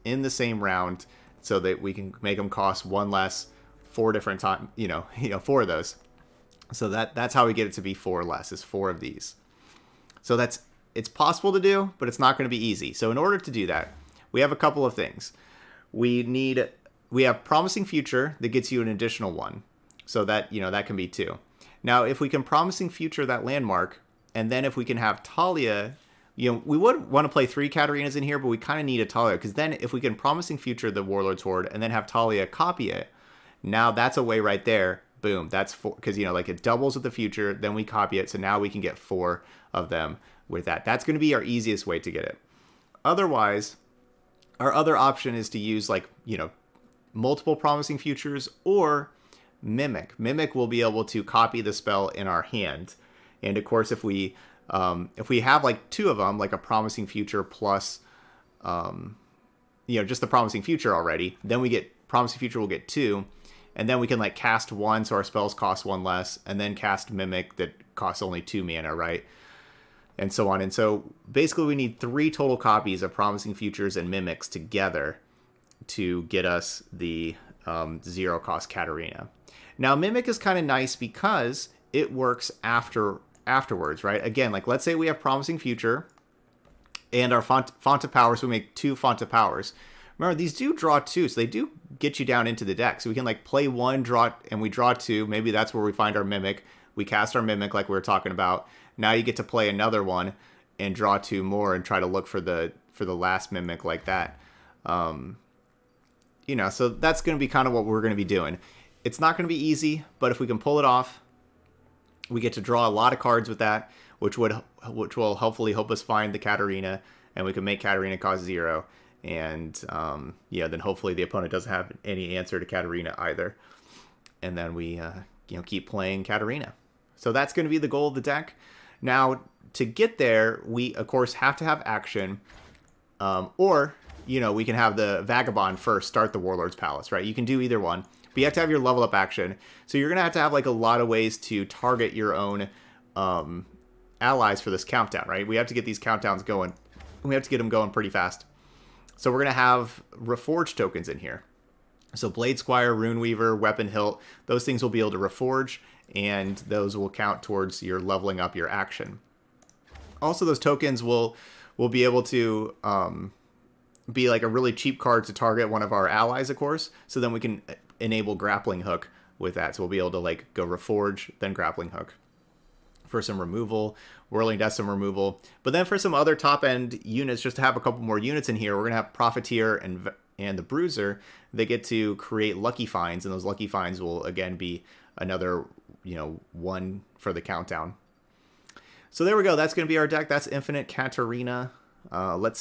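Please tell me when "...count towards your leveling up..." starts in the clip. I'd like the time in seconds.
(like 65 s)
157 s.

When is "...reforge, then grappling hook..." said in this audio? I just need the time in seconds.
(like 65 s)
170 s.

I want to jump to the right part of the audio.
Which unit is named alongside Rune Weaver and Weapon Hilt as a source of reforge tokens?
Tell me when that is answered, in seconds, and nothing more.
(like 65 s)
152 s.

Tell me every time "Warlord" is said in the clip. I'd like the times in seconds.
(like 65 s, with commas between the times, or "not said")
31 s, 136 s.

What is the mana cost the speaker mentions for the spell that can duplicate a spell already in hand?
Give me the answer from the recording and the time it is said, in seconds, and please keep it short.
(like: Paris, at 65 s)
2, at 68 s.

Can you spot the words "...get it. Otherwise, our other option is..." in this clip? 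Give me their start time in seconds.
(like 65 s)
42 s.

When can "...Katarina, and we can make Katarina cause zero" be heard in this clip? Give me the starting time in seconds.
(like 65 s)
116 s.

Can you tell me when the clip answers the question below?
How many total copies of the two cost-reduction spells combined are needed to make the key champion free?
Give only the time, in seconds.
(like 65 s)
71 s.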